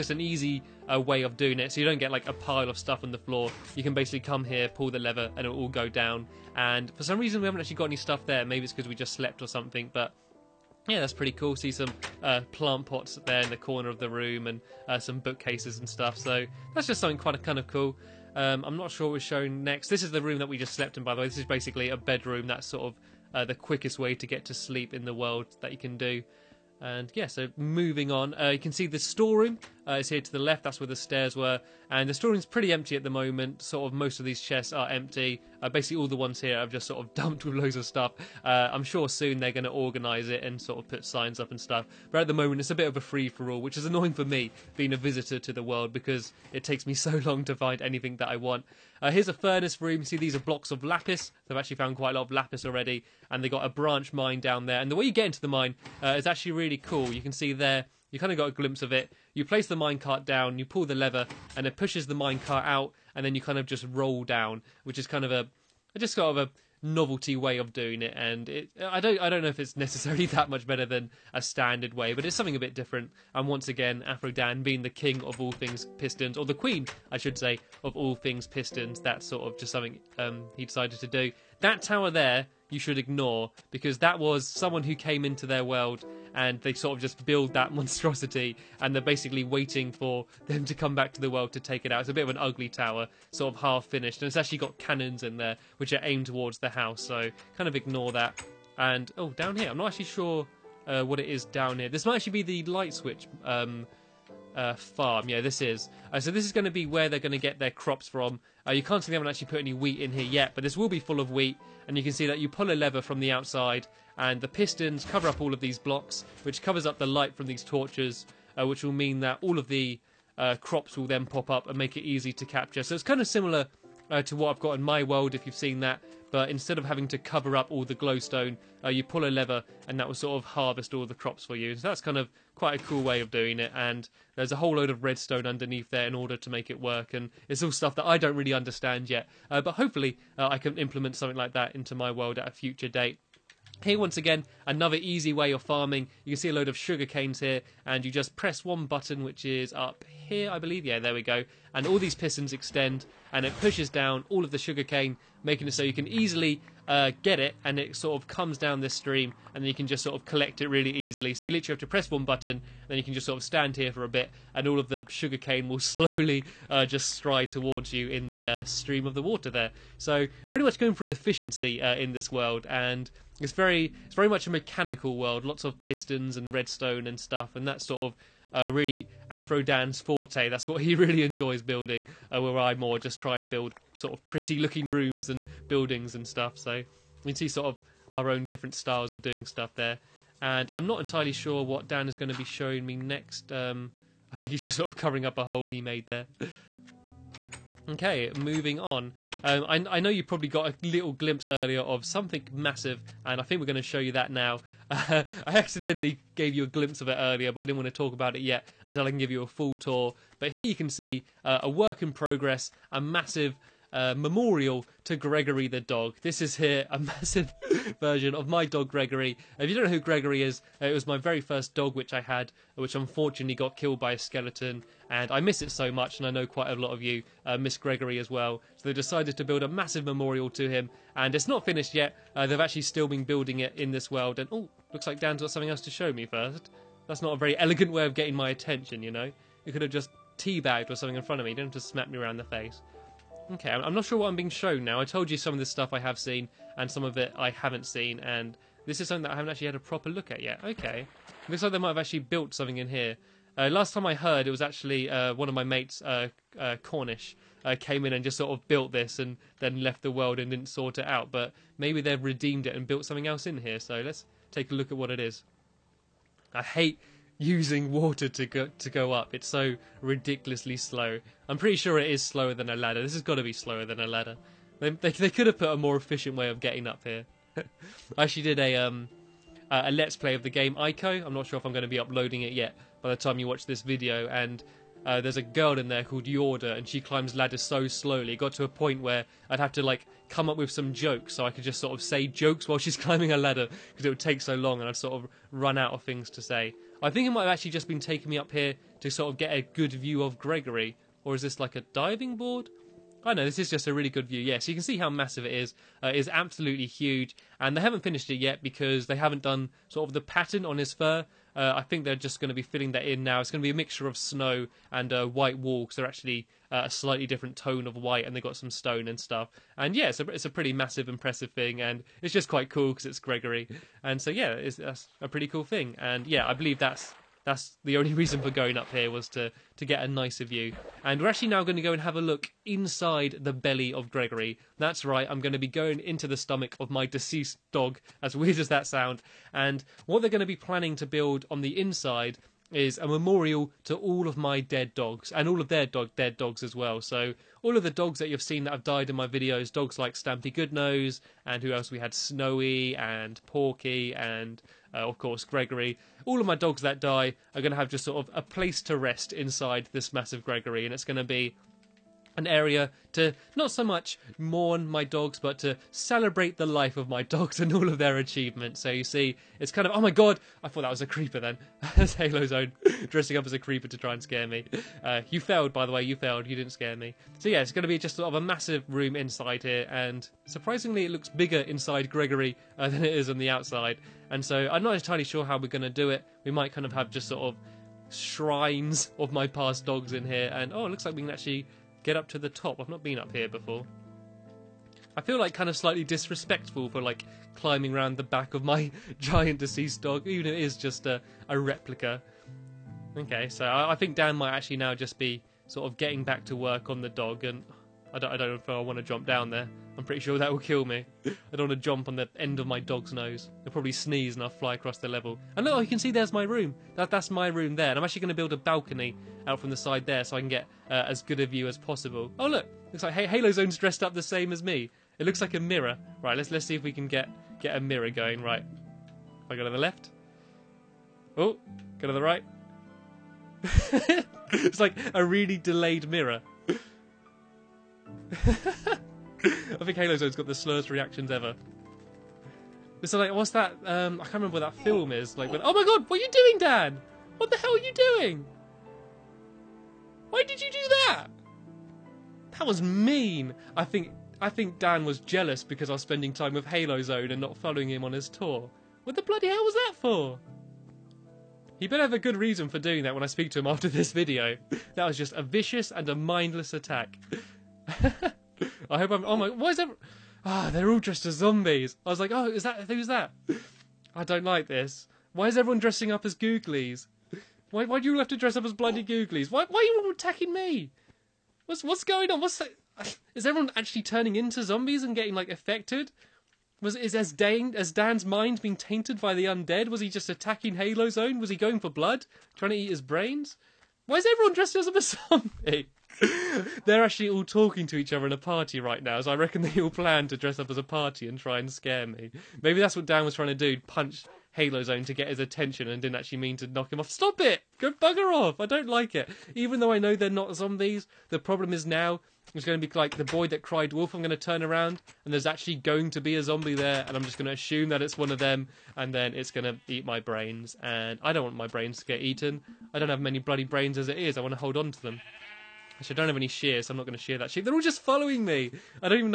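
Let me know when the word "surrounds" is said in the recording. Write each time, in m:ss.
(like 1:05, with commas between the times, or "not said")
not said.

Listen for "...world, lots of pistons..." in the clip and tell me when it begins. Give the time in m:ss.
2:55.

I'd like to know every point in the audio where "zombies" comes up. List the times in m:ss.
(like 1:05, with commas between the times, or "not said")
7:51, 8:04, 8:14, 8:30, 8:36.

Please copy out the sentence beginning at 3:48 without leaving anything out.
So they decided to build a massive memorial to him, and it's not finished yet.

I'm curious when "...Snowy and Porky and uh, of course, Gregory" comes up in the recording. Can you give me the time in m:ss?
5:52.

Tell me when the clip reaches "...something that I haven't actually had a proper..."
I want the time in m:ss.
4:09.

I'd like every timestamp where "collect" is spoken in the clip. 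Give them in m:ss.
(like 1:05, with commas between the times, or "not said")
2:40.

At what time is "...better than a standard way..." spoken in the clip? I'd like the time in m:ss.
1:10.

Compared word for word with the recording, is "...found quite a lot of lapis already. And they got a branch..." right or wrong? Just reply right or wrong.
right.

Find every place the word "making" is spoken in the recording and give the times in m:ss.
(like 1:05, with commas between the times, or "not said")
2:35.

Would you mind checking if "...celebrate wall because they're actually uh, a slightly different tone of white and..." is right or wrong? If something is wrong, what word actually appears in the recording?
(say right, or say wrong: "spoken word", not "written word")
wrong: "white", not "celebrate".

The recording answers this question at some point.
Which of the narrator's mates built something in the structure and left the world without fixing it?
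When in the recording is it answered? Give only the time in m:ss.
4:16.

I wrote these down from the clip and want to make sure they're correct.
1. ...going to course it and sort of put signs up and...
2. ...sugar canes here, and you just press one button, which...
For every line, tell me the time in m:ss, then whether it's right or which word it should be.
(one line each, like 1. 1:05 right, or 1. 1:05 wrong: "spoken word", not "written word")
1. 0:39 wrong: "organise", not "course"
2. 2:26 right.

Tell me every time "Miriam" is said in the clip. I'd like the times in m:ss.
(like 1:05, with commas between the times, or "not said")
not said.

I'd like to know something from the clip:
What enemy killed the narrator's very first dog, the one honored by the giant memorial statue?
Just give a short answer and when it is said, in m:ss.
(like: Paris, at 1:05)
A skeleton, at 3:44.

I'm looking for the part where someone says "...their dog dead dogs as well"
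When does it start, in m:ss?
5:45.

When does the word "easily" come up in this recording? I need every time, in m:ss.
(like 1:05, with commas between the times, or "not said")
2:36, 2:40.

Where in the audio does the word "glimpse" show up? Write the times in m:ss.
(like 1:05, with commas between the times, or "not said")
0:58, 3:21, 3:26.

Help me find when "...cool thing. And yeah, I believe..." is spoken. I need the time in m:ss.
5:25.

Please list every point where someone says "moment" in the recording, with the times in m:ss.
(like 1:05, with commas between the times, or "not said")
0:33, 0:42.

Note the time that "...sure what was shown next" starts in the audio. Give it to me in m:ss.
0:18.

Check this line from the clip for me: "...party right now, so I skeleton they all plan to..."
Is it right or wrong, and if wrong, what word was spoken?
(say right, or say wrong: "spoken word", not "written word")
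wrong: "reckon", not "skeleton".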